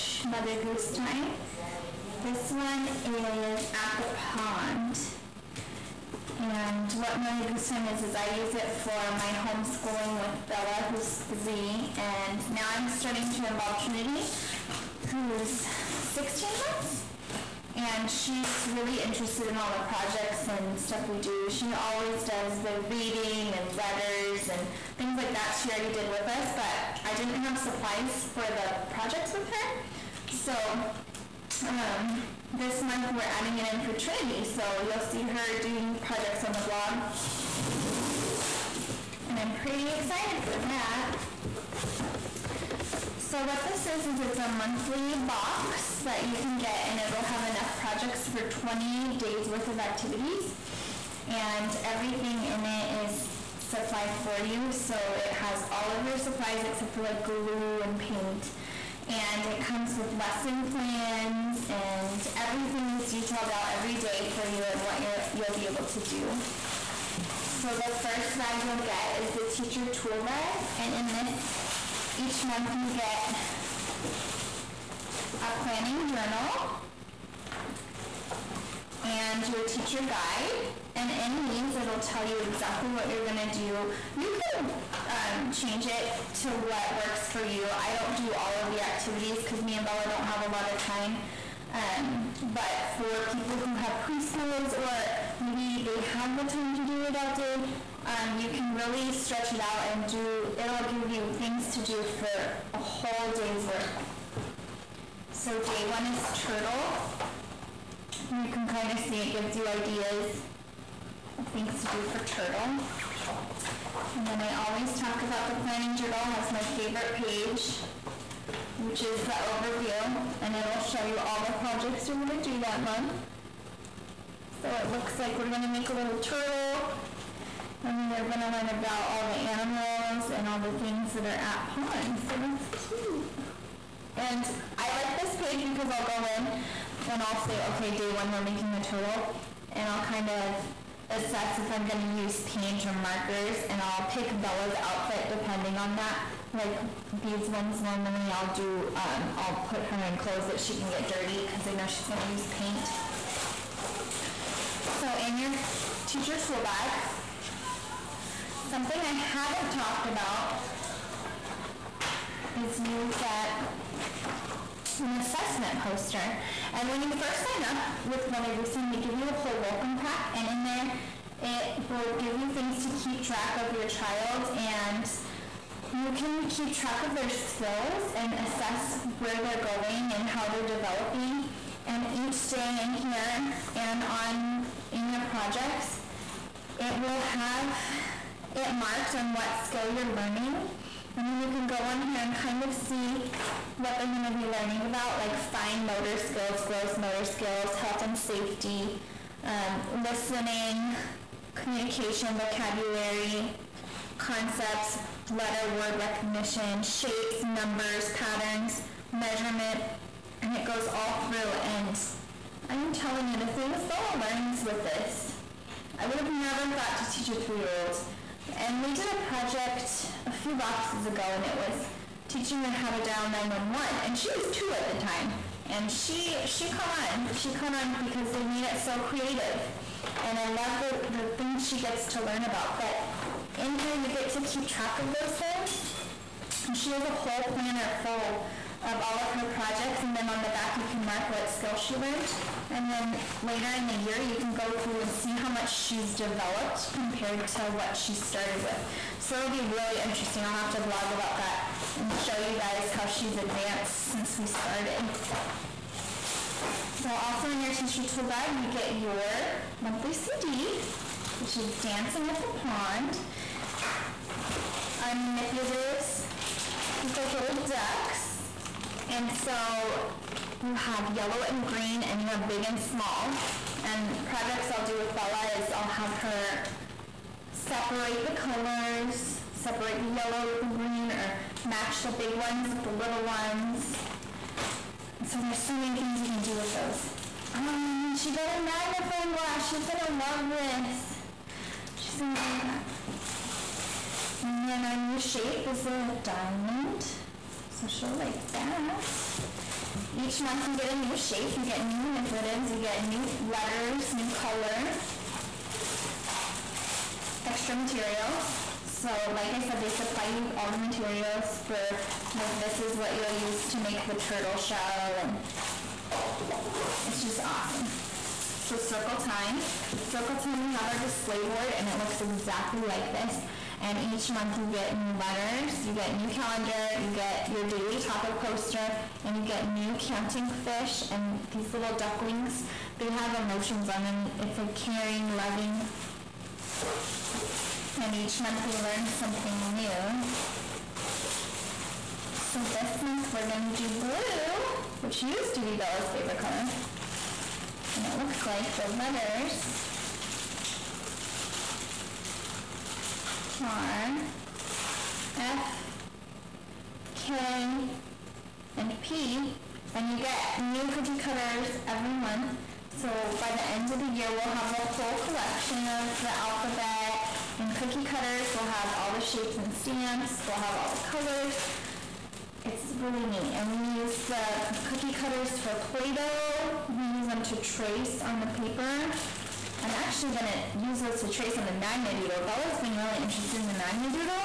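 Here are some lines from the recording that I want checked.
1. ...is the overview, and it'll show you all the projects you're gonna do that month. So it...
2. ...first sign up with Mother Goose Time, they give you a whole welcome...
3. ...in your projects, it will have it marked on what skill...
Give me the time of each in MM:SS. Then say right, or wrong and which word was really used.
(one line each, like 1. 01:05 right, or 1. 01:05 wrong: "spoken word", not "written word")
1. 01:59 right
2. 02:47 right
3. 03:04 right.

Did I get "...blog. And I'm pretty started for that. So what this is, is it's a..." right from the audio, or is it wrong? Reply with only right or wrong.
wrong.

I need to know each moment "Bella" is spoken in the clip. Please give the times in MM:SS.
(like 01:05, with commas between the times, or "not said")
00:10, 01:29, 02:24, 03:33, 04:35, 05:45, 06:22.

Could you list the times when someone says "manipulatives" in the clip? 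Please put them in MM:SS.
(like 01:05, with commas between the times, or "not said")
04:25, 05:02.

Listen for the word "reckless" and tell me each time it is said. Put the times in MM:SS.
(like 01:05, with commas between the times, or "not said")
not said.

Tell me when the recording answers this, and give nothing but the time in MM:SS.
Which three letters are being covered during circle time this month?
05:55.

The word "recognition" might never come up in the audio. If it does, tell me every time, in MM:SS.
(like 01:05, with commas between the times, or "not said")
03:25.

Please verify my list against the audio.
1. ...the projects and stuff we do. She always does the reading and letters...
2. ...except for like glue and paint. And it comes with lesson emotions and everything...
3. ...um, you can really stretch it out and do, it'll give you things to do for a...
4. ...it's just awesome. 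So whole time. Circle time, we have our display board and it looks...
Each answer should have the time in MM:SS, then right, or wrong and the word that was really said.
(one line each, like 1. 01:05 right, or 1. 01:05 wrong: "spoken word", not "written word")
1. 00:19 right
2. 00:56 wrong: "plans", not "emotions"
3. 01:38 right
4. 05:17 wrong: "circle", not "whole".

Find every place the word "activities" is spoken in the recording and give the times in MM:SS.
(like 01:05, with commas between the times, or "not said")
00:49, 01:28.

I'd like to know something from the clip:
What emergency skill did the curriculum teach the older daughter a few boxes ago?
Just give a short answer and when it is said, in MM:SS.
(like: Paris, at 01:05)
Dialing 911, at 03:43.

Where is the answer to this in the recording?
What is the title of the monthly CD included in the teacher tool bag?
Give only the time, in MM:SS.
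04:21.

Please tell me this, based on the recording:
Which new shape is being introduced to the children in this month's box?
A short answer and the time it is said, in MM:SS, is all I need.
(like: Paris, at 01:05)
Diamond, at 04:55.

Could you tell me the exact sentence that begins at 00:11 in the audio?
And now I'm starting to involve Trinity, who's 16 months.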